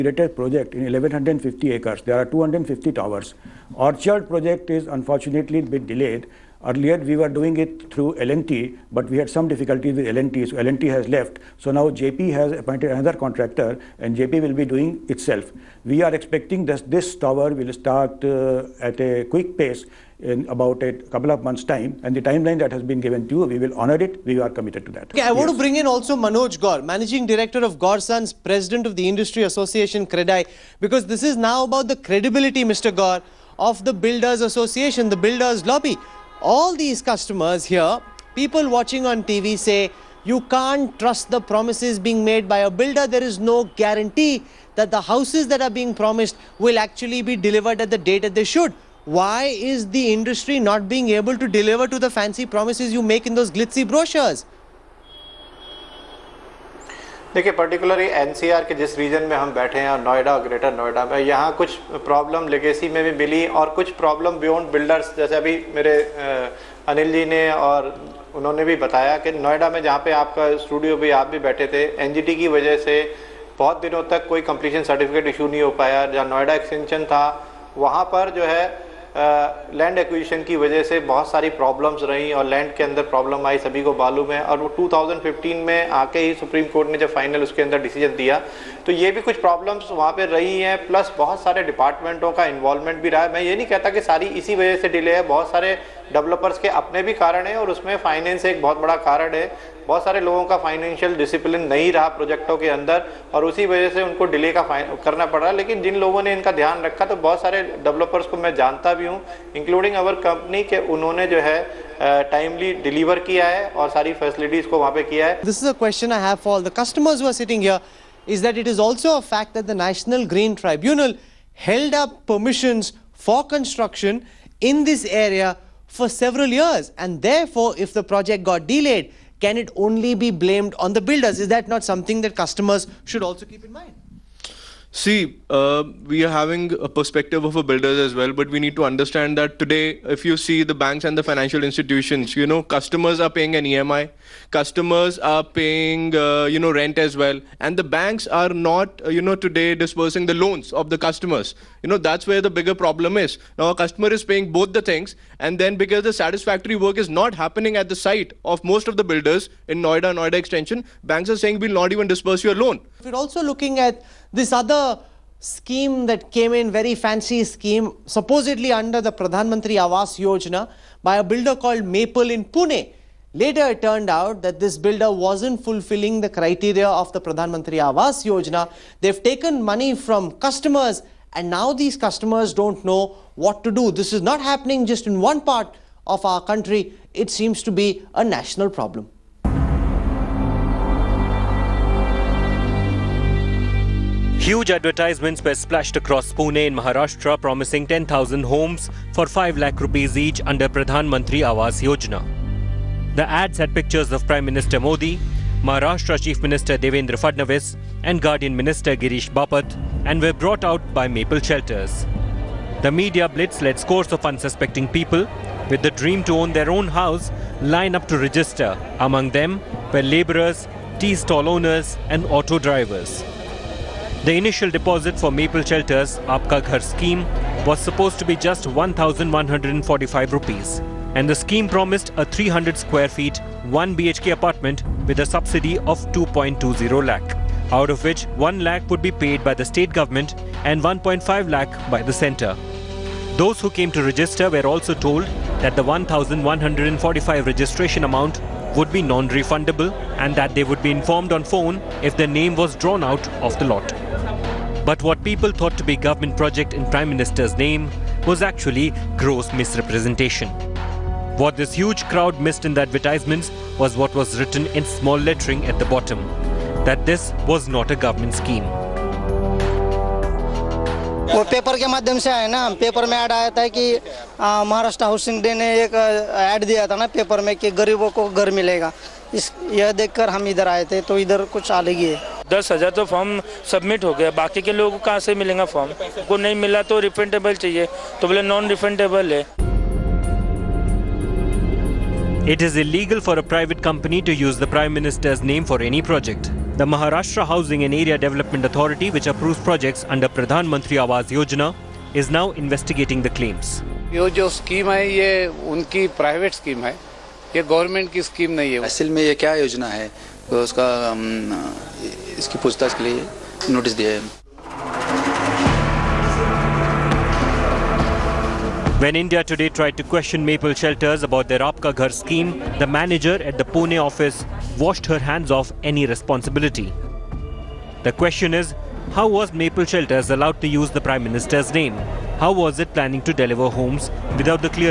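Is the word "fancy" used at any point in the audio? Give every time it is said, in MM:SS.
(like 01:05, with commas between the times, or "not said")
00:52, 02:47.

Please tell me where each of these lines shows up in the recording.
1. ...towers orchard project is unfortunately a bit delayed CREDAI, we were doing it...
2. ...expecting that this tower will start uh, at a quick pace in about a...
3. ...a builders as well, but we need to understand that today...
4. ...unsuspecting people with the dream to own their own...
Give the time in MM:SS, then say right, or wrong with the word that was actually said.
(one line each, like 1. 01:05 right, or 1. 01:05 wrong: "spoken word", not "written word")
1. 00:02 wrong: "Earlier", not "CREDAI"
2. 00:16 right
3. 02:17 right
4. 03:34 right.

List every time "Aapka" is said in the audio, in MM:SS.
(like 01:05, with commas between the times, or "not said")
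03:46, 05:21.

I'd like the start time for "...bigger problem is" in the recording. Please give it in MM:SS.
02:32.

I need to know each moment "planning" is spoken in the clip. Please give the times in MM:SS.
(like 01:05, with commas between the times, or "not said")
05:32.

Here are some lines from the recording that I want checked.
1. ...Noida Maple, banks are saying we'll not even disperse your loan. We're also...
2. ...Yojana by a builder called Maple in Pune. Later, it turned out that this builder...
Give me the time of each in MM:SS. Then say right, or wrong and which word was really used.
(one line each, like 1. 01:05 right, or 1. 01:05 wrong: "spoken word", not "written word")
1. 02:40 wrong: "Extension", not "Maple"
2. 02:50 right.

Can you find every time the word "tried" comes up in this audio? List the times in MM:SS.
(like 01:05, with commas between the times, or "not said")
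05:19.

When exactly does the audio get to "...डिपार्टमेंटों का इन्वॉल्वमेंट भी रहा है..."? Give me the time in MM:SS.
01:31.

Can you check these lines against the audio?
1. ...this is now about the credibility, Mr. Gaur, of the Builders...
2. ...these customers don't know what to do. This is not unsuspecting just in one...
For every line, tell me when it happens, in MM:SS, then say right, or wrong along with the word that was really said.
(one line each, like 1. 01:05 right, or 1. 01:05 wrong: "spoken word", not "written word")
1. 00:31 right
2. 03:01 wrong: "happening", not "unsuspecting".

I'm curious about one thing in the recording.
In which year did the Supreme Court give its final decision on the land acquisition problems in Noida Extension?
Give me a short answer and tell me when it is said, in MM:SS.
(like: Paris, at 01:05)
2015, at 01:24.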